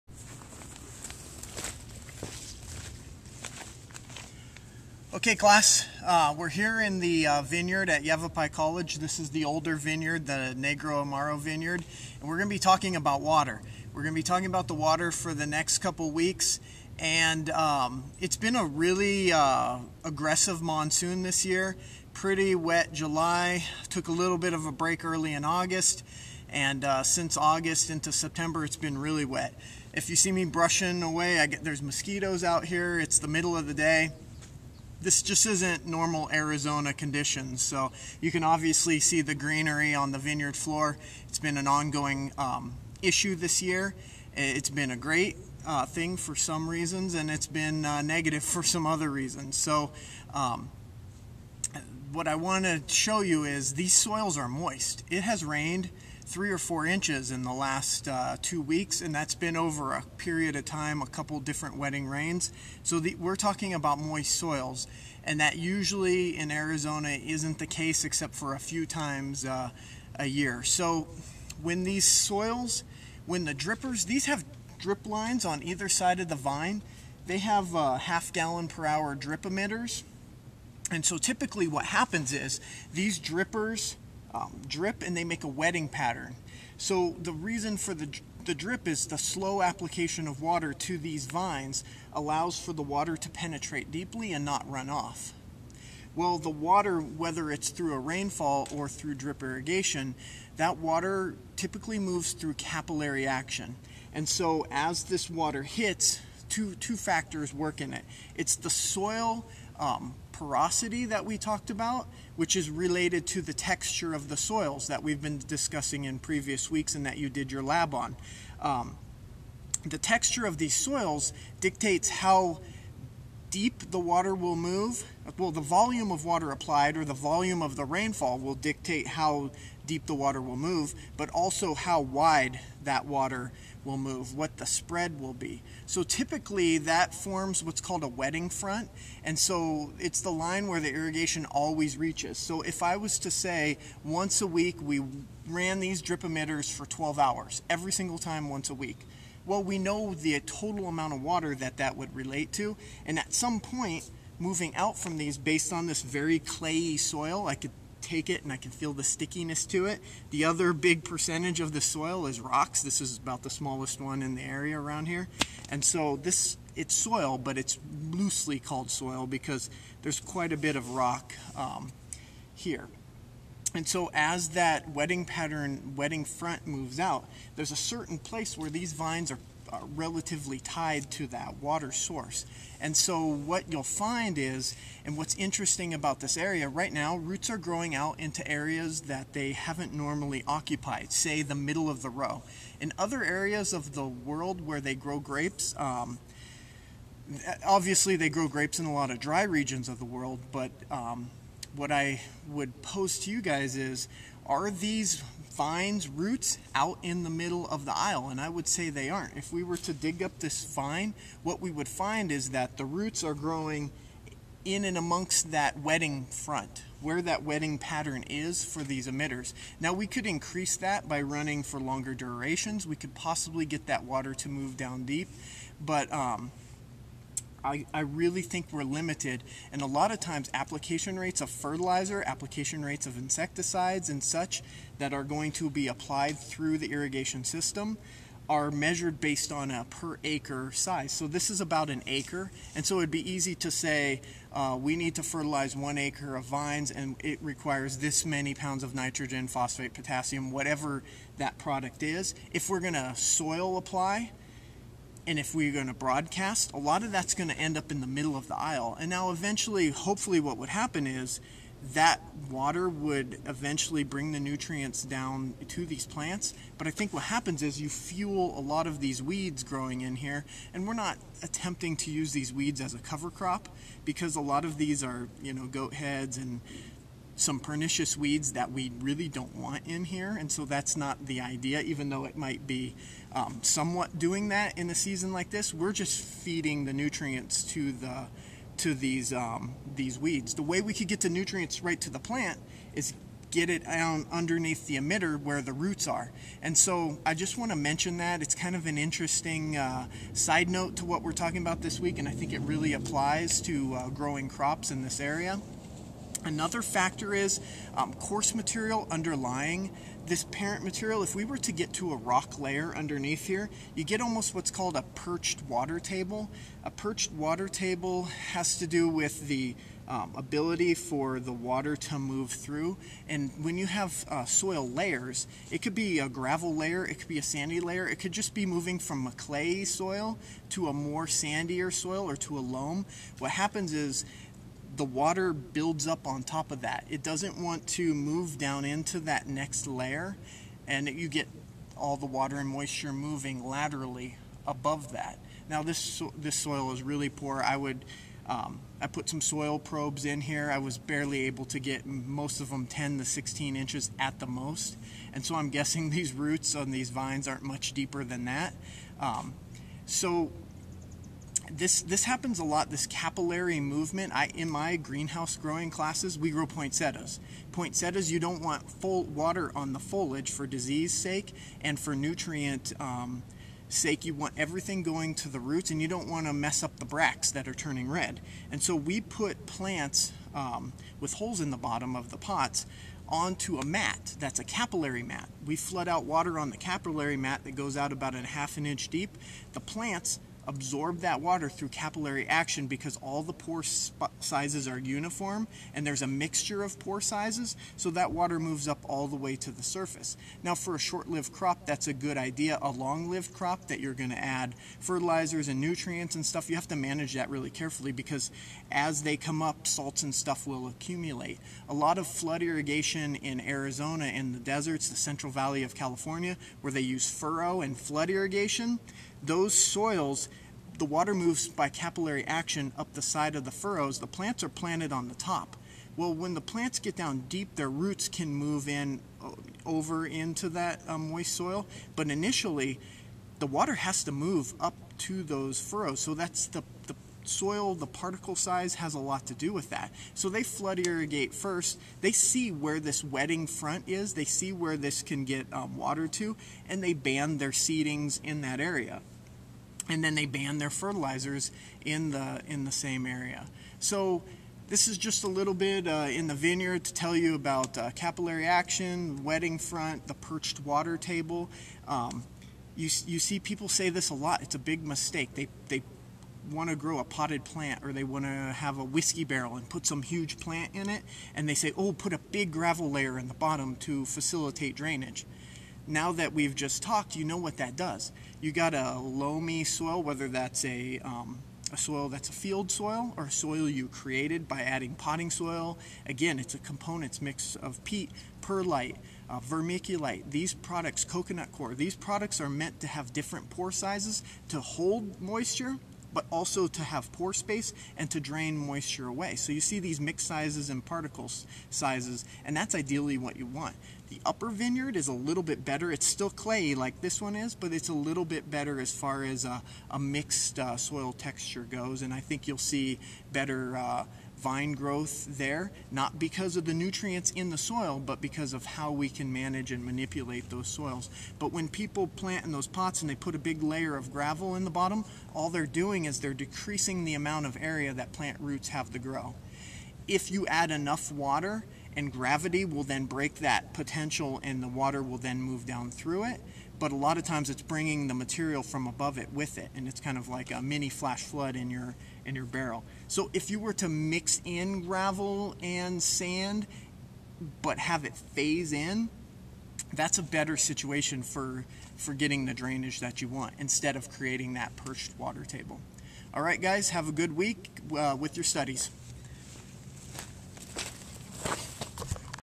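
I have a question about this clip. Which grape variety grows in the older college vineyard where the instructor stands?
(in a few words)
Negroamaro.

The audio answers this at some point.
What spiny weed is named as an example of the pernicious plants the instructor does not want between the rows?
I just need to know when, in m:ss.
4:35.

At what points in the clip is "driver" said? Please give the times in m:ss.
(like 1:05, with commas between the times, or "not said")
not said.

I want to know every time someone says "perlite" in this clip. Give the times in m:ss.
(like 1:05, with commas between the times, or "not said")
8:08.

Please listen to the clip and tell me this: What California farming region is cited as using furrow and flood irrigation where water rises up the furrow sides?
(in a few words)
Central Valley.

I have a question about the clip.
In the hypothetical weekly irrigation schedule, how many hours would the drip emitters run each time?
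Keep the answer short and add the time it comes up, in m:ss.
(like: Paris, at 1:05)
12 hours, at 2:26.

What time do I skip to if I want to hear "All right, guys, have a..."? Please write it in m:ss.
9:16.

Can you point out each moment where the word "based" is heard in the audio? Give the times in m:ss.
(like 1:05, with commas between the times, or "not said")
2:35, 3:59.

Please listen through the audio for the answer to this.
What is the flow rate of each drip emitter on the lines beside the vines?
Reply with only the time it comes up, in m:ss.
1:17.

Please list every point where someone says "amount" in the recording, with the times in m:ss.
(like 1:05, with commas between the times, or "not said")
2:30, 8:47.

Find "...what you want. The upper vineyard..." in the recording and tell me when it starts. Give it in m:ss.
8:23.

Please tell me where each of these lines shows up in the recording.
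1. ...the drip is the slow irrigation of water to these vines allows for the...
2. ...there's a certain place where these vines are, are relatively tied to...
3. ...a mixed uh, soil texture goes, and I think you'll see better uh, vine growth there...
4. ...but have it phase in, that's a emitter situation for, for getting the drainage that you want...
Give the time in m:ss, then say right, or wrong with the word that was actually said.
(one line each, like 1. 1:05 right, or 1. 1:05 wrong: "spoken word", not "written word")
1. 1:28 wrong: "application", not "irrigation"
2. 2:57 right
3. 8:30 right
4. 9:07 wrong: "better", not "emitter".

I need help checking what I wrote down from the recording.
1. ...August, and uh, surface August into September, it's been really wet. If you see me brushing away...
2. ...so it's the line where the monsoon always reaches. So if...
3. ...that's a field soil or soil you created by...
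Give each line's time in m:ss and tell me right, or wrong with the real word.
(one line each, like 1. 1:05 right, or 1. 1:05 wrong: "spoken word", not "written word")
1. 0:25 wrong: "since", not "surface"
2. 2:19 wrong: "irrigation", not "monsoon"
3. 8:02 right.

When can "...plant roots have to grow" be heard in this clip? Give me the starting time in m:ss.
8:48.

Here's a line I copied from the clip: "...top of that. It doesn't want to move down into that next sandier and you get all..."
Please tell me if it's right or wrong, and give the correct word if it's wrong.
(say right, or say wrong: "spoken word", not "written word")
wrong: "layer", not "sandier".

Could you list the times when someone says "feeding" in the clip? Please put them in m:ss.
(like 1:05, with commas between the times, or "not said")
4:46.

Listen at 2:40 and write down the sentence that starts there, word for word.
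The other big percentage of the soil is rocks.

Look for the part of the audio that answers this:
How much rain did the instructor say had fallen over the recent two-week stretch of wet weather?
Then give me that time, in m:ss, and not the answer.
0:56.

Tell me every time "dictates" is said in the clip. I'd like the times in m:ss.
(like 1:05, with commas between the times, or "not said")
2:01, 2:08.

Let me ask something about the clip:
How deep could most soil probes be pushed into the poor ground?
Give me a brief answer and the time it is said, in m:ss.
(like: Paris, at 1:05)
10 to 16 inches, at 5:52.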